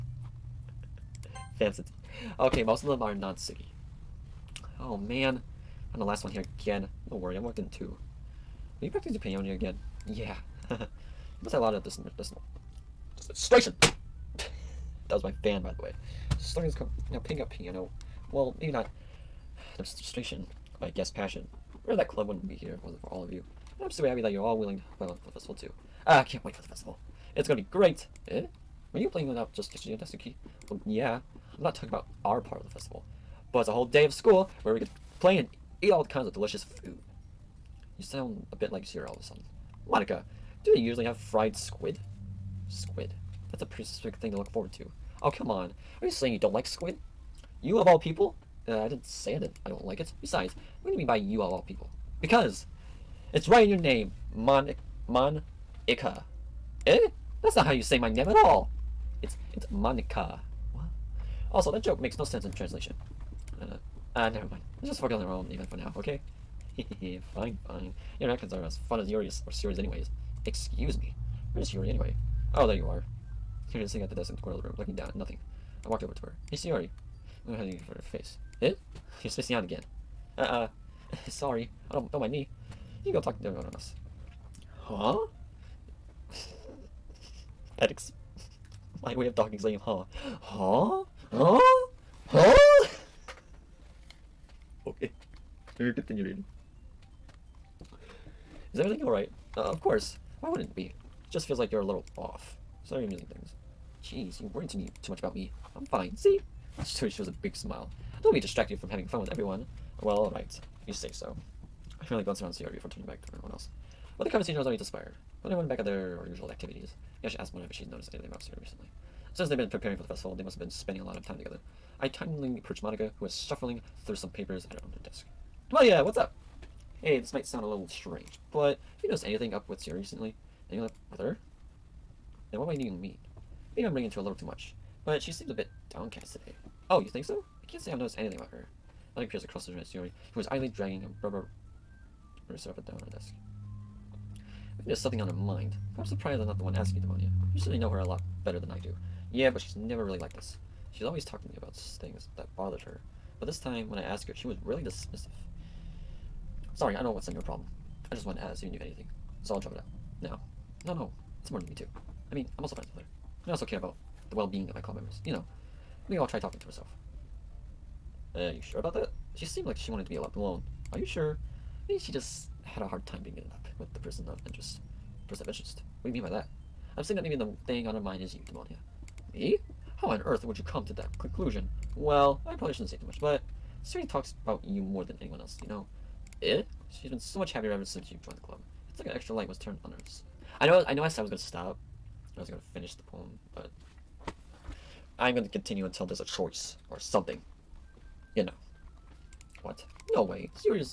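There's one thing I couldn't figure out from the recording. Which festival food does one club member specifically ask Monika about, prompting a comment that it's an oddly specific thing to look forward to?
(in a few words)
Fried squid.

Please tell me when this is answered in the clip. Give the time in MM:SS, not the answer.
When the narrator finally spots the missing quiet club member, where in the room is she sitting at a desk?
01:14.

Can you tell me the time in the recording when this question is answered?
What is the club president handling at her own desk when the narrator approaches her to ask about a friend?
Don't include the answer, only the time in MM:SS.
02:04.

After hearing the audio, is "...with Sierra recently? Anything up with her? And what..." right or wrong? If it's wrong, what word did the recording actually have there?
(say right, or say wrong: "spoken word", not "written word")
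right.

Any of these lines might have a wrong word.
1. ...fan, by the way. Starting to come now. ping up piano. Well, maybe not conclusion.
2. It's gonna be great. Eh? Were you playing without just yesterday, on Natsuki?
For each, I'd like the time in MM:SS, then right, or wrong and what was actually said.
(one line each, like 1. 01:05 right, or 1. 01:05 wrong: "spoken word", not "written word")
1. 00:15 wrong: "demonstration", not "conclusion"
2. 00:27 right.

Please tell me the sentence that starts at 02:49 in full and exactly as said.
She seemed like she wanted to be left alone.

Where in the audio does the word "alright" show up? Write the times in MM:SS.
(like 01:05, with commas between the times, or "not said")
01:39, 01:50.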